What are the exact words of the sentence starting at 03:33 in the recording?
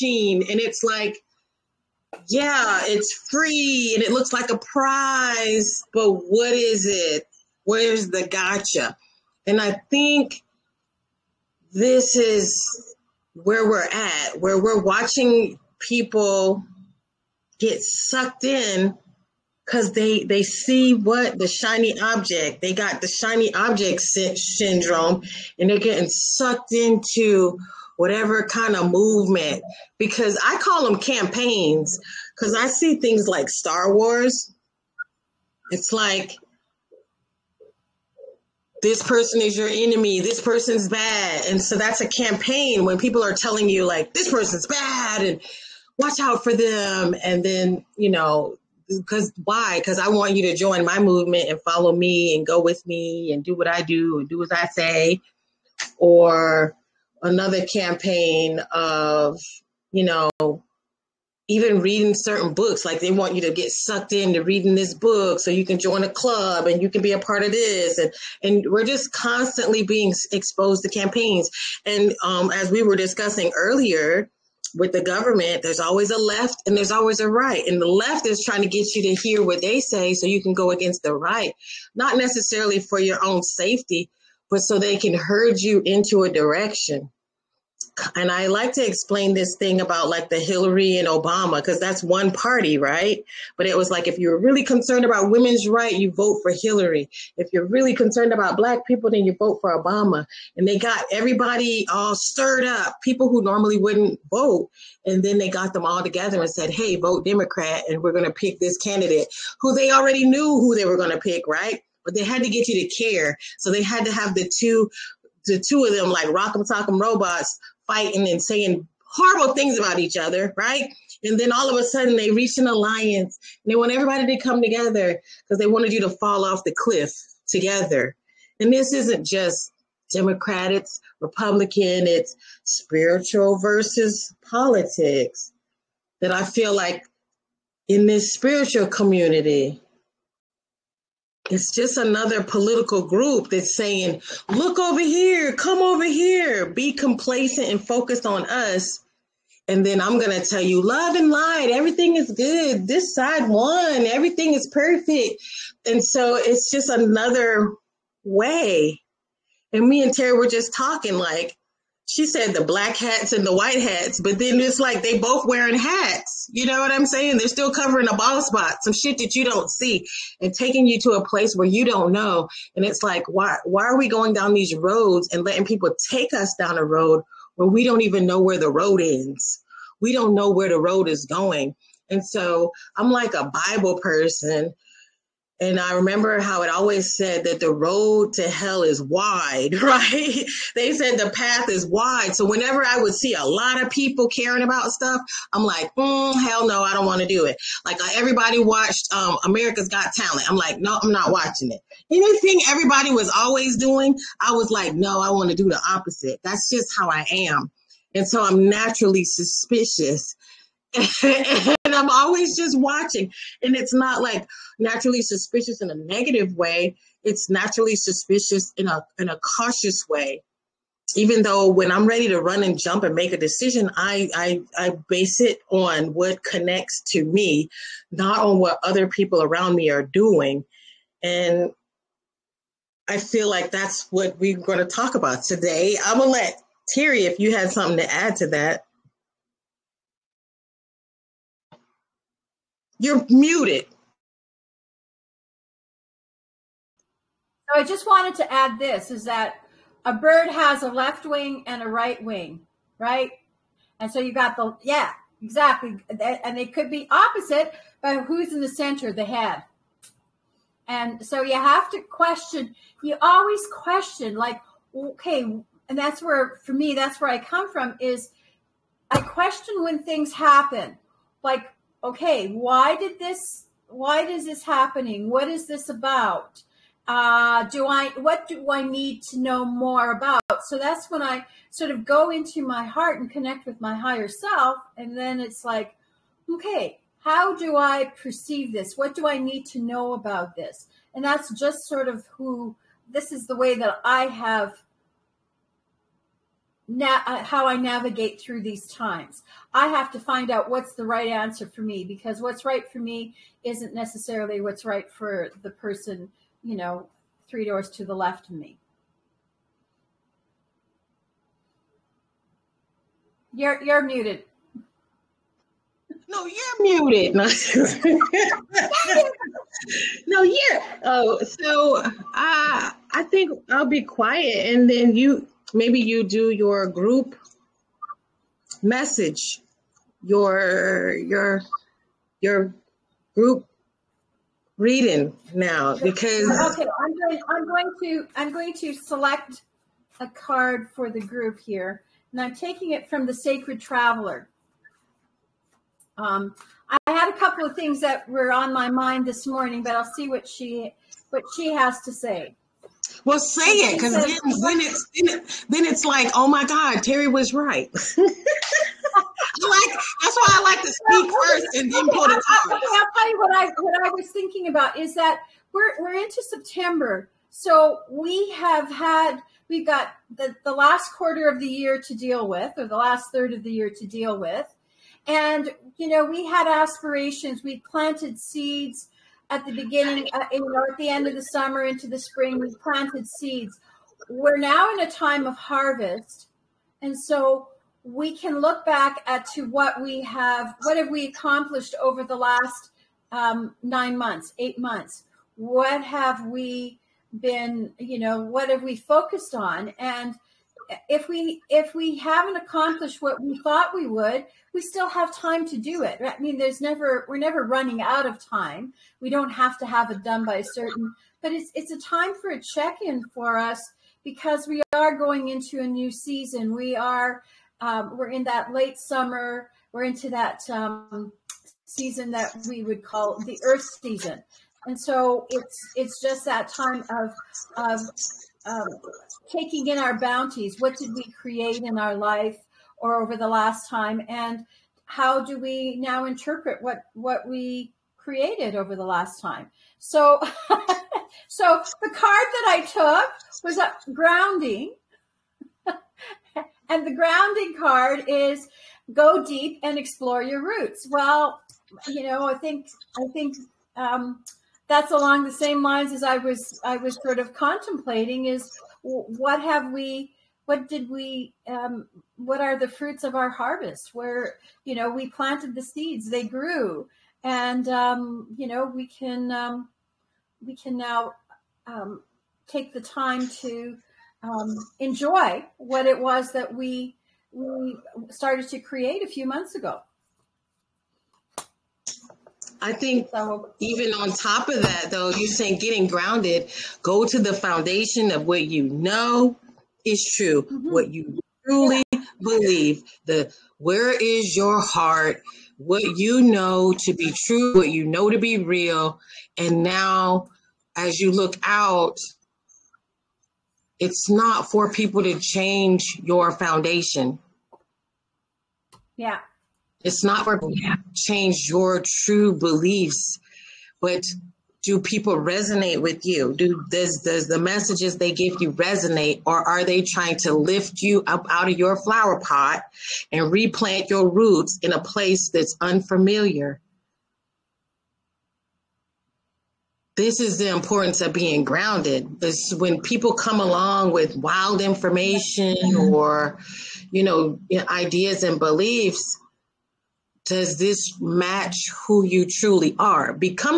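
And it's not like naturally suspicious in a negative way.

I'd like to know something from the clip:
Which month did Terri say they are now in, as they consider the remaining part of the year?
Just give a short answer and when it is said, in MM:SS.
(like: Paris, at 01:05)
September, at 06:06.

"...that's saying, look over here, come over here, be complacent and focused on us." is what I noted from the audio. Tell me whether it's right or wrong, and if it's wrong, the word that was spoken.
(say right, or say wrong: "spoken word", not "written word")
right.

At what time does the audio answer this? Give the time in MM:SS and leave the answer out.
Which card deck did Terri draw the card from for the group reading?
05:43.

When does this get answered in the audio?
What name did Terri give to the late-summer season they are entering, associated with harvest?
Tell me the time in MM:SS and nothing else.
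07:03.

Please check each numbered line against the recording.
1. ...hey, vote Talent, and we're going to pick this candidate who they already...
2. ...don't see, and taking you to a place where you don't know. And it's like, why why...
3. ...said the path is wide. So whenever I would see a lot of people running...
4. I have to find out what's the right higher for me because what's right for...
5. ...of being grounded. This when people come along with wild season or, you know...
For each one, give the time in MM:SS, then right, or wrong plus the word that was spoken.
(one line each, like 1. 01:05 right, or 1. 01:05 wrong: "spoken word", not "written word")
1. 01:46 wrong: "Democrat", not "Talent"
2. 02:49 right
3. 03:10 wrong: "caring", not "running"
4. 04:59 wrong: "answer", not "higher"
5. 08:51 wrong: "information", not "season".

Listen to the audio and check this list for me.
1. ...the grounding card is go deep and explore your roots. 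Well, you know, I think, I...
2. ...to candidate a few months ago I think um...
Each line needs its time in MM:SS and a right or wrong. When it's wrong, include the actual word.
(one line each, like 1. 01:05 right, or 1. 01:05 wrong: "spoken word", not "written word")
1. 07:27 right
2. 07:58 wrong: "create", not "candidate".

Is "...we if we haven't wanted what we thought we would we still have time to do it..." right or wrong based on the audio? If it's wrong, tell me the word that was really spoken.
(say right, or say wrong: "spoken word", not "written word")
wrong: "accomplished", not "wanted".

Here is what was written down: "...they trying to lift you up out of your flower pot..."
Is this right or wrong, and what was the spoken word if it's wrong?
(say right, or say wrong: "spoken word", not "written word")
right.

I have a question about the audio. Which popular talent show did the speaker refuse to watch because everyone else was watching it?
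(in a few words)
America's Got Talent.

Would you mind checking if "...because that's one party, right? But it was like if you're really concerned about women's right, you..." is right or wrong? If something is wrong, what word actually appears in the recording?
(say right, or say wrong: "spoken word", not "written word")
right.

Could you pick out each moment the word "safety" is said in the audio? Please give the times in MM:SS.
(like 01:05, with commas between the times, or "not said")
01:23.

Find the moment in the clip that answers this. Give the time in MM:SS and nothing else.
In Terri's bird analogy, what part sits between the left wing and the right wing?
04:19.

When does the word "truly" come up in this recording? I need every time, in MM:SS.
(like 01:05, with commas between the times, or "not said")
08:11, 09:02.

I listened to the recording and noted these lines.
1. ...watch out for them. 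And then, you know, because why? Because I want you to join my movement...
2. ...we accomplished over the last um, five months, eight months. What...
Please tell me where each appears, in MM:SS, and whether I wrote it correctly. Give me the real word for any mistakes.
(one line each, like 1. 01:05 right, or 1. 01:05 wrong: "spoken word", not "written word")
1. 00:45 right
2. 06:31 wrong: "nine", not "five".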